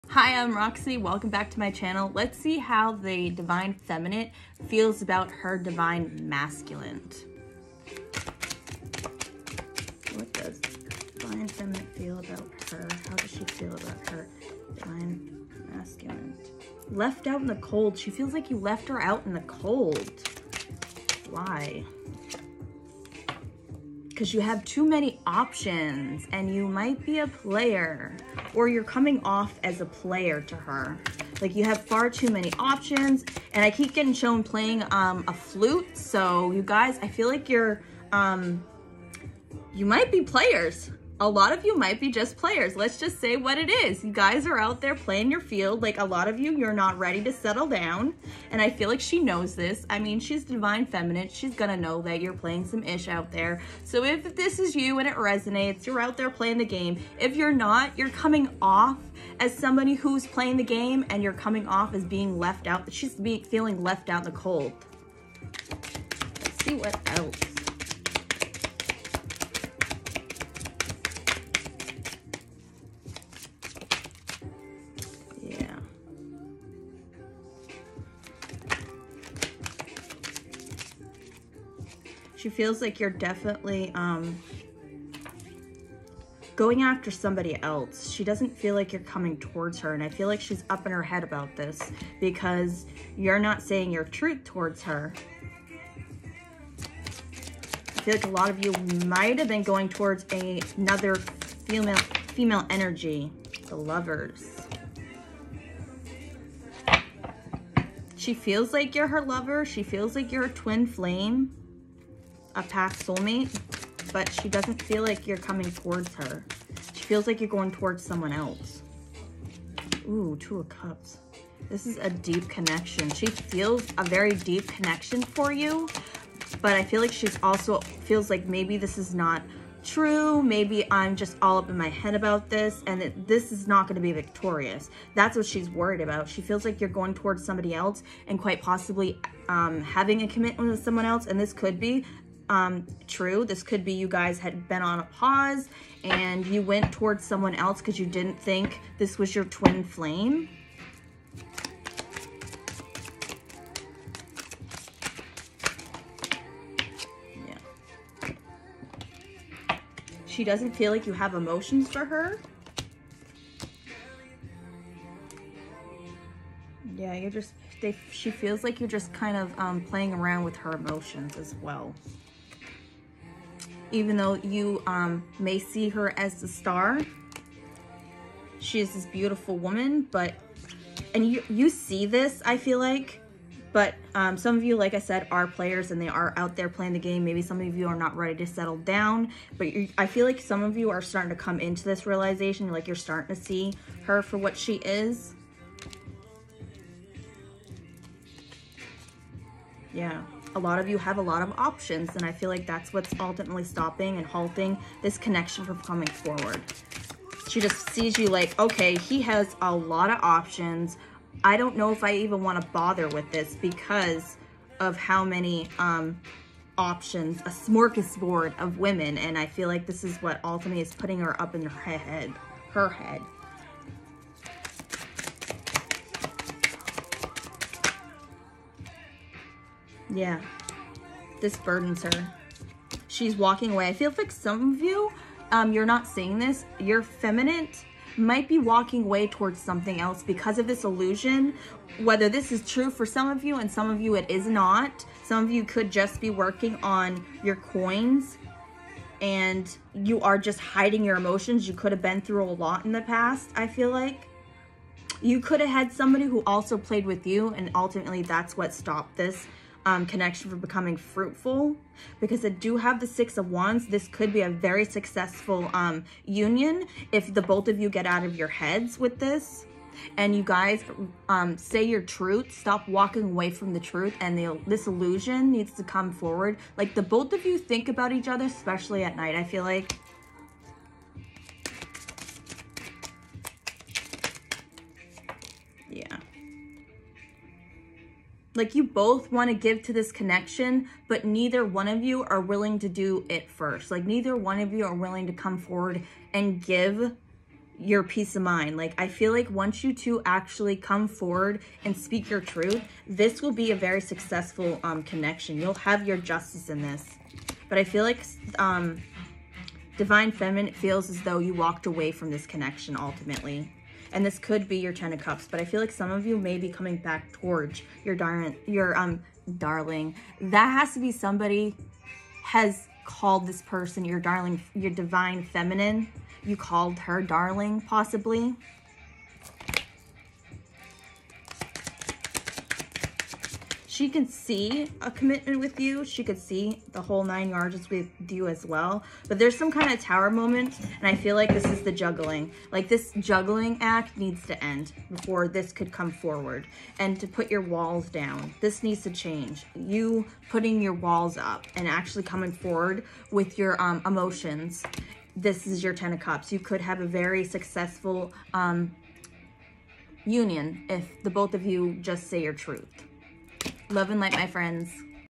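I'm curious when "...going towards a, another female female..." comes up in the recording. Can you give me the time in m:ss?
1:39.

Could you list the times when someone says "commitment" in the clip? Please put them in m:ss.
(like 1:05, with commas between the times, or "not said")
2:20, 5:35.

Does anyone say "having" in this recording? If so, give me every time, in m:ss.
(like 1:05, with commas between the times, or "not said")
2:19.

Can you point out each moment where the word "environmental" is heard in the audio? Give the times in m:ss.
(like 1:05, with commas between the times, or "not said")
not said.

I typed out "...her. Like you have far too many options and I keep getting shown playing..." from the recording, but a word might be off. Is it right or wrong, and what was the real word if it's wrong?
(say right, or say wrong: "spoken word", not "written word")
right.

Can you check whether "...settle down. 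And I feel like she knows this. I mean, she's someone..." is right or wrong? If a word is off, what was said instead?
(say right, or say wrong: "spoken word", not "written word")
wrong: "divine", not "someone".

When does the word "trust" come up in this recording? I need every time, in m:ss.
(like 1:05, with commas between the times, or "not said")
not said.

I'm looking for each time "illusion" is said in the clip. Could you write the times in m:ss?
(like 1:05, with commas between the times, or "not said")
4:00, 4:34.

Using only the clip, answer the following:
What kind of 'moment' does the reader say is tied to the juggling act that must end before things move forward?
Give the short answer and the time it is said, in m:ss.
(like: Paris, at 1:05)
Tower moment, at 5:40.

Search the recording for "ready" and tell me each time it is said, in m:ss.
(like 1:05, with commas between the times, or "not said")
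0:46, 3:08.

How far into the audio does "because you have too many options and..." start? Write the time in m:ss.
0:24.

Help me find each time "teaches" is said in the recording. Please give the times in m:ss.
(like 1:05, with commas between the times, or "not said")
not said.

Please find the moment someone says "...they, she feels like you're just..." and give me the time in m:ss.
2:47.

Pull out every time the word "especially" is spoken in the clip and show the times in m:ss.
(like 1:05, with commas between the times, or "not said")
4:38.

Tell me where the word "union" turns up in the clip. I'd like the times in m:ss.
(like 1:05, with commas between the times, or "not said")
4:26, 6:00.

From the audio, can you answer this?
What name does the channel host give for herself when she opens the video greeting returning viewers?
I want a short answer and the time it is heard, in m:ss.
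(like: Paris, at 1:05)
Roxy, at 0:00.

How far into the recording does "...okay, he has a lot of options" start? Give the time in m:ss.
3:28.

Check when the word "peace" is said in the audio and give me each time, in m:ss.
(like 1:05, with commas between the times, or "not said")
4:58.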